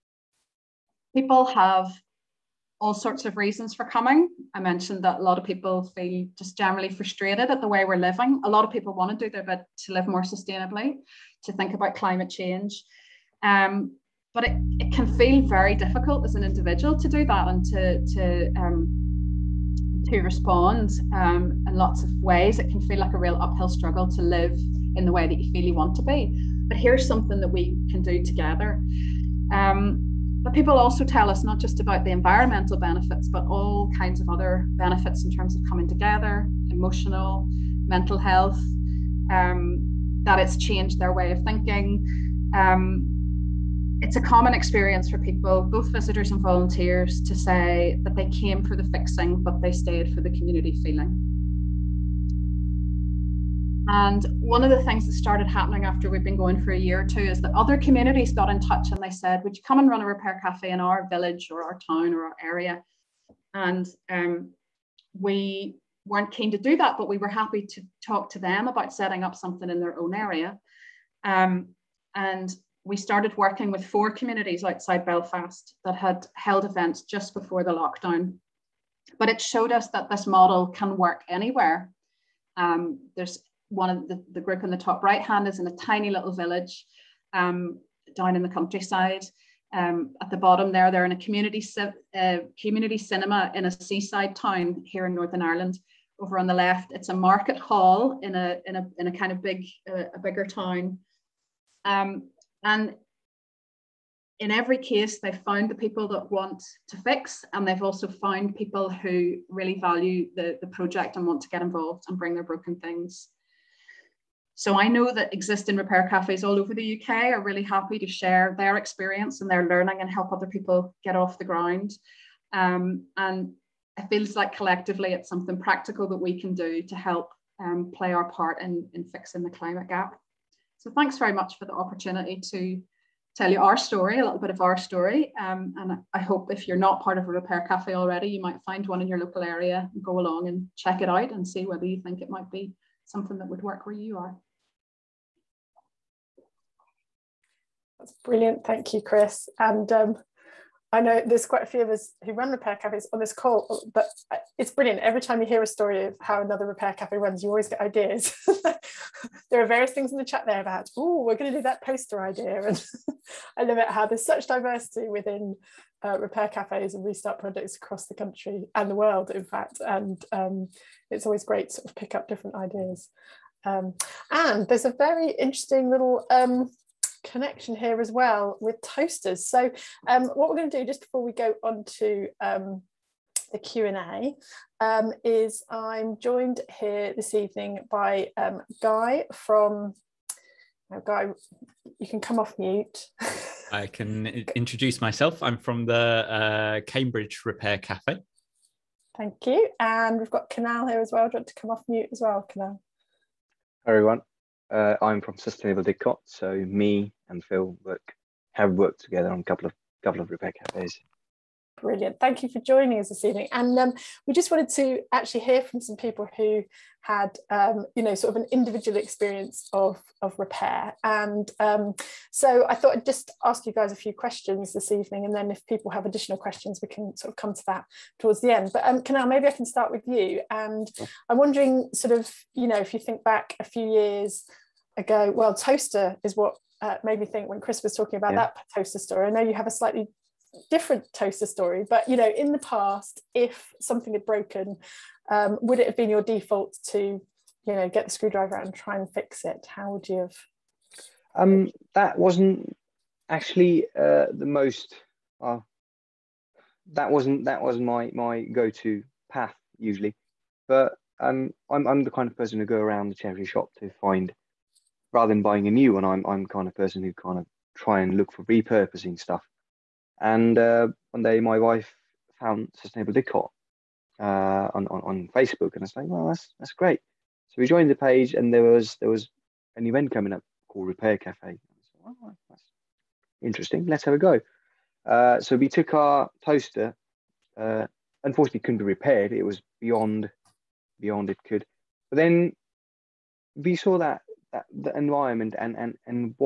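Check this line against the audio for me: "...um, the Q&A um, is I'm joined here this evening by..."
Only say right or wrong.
right.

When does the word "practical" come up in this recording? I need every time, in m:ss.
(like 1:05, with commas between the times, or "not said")
2:05.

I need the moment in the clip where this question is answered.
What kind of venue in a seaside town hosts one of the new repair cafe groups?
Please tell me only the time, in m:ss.
1:32.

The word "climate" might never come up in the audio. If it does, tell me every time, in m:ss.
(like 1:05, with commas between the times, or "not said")
0:11, 2:09.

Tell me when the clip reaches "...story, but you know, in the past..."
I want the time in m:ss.
4:01.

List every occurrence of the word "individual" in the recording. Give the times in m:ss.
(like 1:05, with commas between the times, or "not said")
0:16, 3:38.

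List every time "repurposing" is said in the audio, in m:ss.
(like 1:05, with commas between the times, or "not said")
4:28.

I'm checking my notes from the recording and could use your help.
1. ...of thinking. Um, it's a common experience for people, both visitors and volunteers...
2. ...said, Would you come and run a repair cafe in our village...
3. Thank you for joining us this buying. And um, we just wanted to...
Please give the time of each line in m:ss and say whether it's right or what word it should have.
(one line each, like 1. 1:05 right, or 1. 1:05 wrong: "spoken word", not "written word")
1. 0:41 right
2. 0:59 right
3. 3:32 wrong: "evening", not "buying".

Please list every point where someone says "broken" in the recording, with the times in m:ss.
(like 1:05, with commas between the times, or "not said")
1:52, 4:04.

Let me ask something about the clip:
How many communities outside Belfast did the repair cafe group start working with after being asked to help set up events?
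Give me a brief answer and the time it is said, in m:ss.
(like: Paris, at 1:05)
4, at 1:13.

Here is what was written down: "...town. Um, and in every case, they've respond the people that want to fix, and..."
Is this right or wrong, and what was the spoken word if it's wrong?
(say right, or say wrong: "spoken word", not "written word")
wrong: "found", not "respond".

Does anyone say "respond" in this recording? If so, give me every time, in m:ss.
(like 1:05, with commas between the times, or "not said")
0:20.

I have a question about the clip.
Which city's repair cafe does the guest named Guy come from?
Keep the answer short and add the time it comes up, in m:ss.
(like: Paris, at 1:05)
Cambridge, at 3:16.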